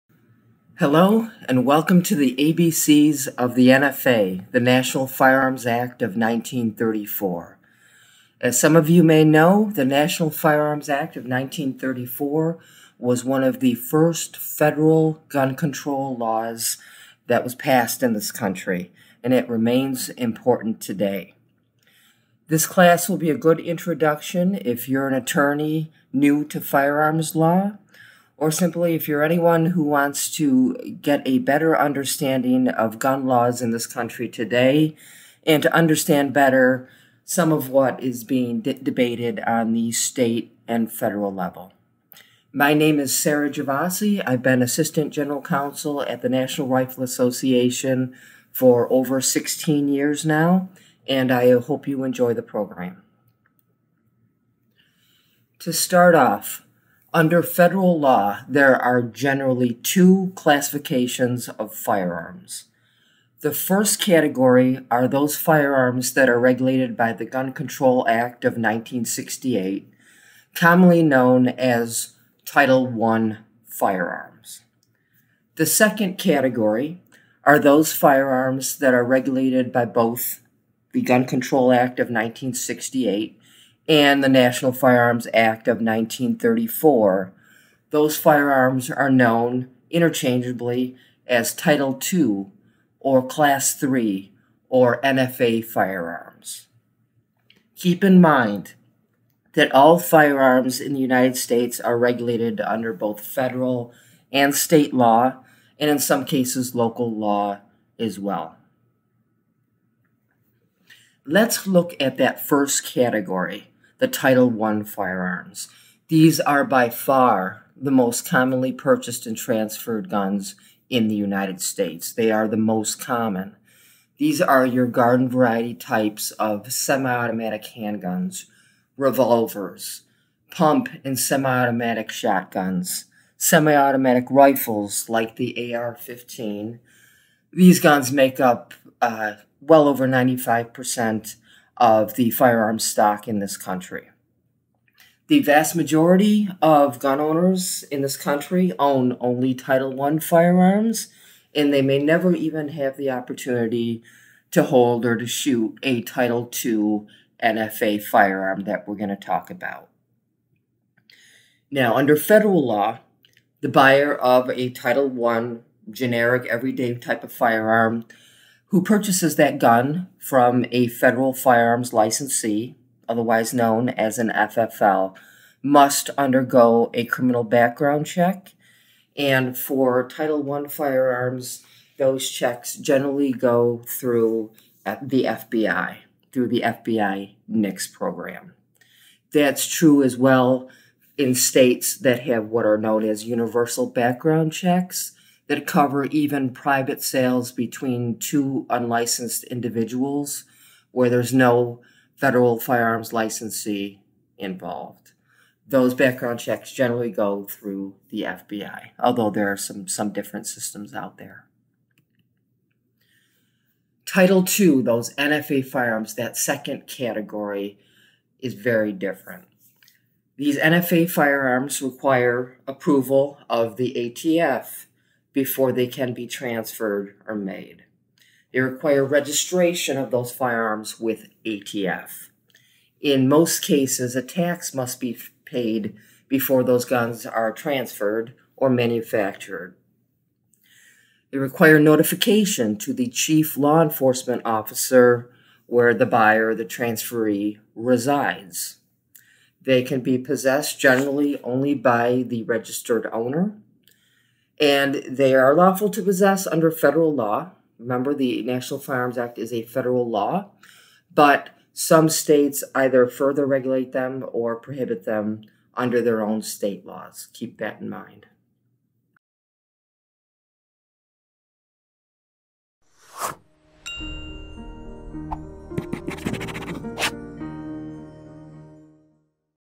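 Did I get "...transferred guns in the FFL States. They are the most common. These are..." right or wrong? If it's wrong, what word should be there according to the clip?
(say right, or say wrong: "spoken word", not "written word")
wrong: "United", not "FFL".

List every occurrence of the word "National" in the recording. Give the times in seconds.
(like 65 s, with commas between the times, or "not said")
4 s, 9 s, 46 s, 84 s, 258 s.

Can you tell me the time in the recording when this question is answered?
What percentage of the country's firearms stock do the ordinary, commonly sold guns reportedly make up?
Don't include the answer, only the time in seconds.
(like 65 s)
139 s.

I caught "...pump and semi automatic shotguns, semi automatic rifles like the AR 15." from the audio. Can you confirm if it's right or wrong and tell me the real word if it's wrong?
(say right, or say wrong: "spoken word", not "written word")
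right.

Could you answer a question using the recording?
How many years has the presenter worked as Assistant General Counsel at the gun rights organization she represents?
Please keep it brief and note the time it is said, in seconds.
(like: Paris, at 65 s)
over 16 years, at 48 s.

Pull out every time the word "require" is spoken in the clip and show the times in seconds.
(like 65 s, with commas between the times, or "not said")
221 s, 228 s, 241 s.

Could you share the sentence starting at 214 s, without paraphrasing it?
Title II, those NFA firearms, that second category, is very different.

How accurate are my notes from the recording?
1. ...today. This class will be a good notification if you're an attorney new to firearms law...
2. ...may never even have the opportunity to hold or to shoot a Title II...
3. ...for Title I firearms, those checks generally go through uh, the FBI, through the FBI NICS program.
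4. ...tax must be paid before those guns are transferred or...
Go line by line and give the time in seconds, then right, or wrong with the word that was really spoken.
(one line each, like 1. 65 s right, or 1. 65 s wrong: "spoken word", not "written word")
1. 20 s wrong: "introduction", not "notification"
2. 151 s right
3. 179 s right
4. 234 s right.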